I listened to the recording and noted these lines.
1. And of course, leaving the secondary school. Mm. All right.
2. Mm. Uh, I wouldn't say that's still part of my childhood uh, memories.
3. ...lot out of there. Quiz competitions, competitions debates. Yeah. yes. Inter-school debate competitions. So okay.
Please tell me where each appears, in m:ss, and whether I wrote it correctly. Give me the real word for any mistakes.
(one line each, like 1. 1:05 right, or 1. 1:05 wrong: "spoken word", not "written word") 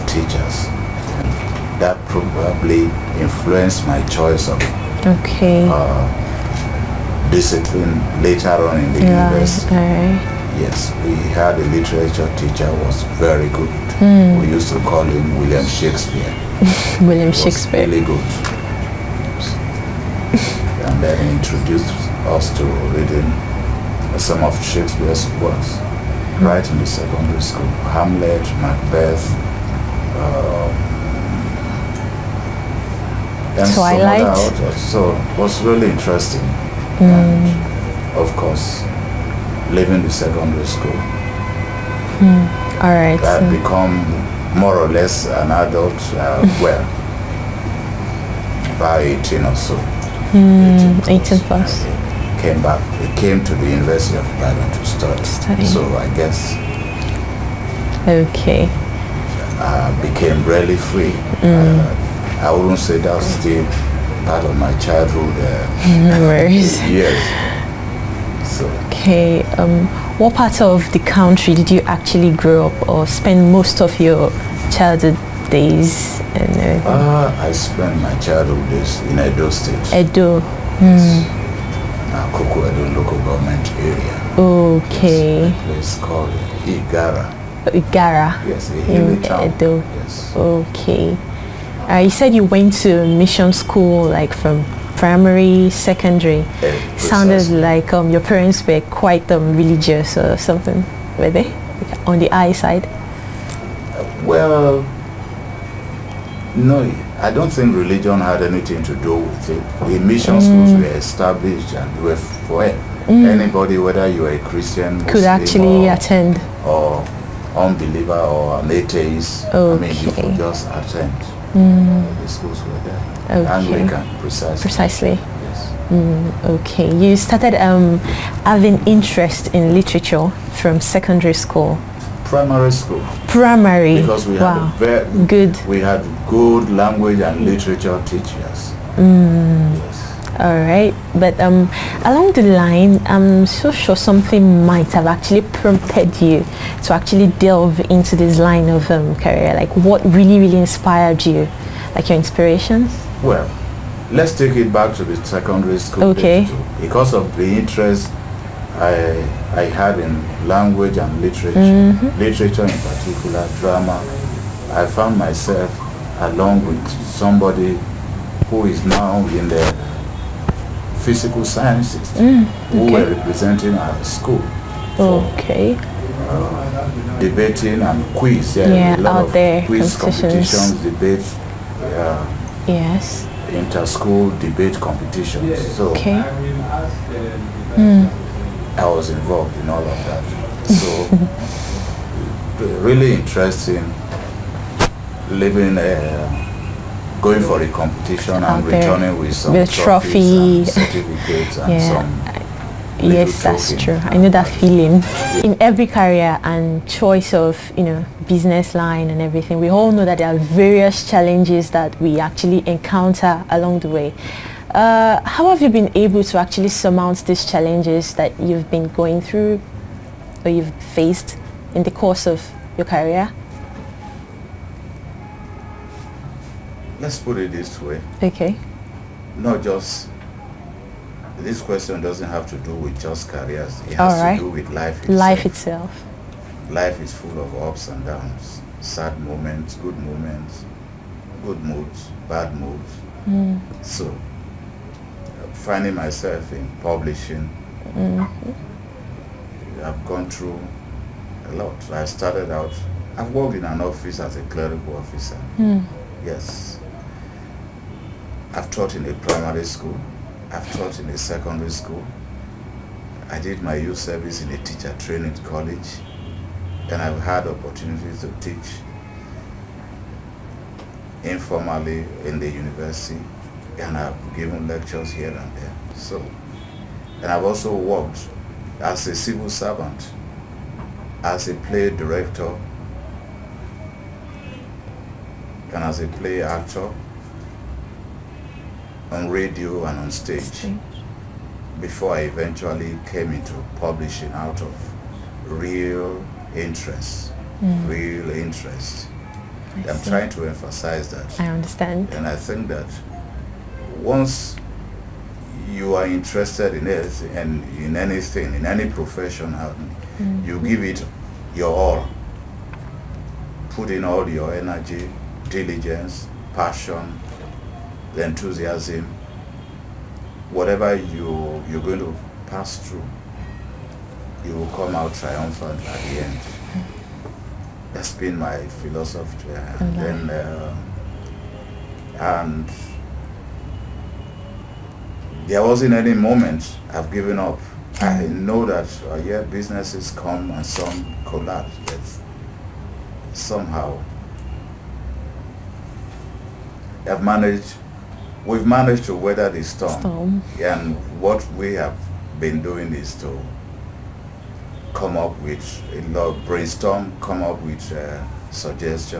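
1. 0:37 right
2. 1:01 right
3. 2:58 right.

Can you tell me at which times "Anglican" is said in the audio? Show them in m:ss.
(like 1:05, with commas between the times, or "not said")
2:03.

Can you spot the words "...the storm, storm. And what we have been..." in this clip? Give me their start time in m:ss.
5:49.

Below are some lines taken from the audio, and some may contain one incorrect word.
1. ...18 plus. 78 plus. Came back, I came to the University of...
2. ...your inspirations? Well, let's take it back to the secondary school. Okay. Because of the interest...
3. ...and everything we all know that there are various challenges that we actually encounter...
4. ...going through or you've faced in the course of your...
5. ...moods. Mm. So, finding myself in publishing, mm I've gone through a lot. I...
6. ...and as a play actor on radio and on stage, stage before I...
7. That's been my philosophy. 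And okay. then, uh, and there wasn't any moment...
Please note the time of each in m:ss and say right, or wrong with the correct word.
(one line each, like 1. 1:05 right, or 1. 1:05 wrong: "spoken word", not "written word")
1. 0:51 wrong: "18", not "78"
2. 2:32 right
3. 3:29 right
4. 3:38 right
5. 4:02 right
6. 4:45 right
7. 5:27 right.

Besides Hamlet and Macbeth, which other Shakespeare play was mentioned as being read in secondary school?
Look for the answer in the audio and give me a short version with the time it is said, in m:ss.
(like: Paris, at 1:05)
Twelfth Night, at 0:33.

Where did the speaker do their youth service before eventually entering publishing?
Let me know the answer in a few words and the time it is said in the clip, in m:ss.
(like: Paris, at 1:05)
teacher training college, at 4:24.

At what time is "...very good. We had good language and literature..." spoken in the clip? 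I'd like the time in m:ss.
2:14.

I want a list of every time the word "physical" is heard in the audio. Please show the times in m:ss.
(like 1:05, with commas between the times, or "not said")
2:50.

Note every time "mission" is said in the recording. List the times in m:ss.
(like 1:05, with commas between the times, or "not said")
1:33, 1:49.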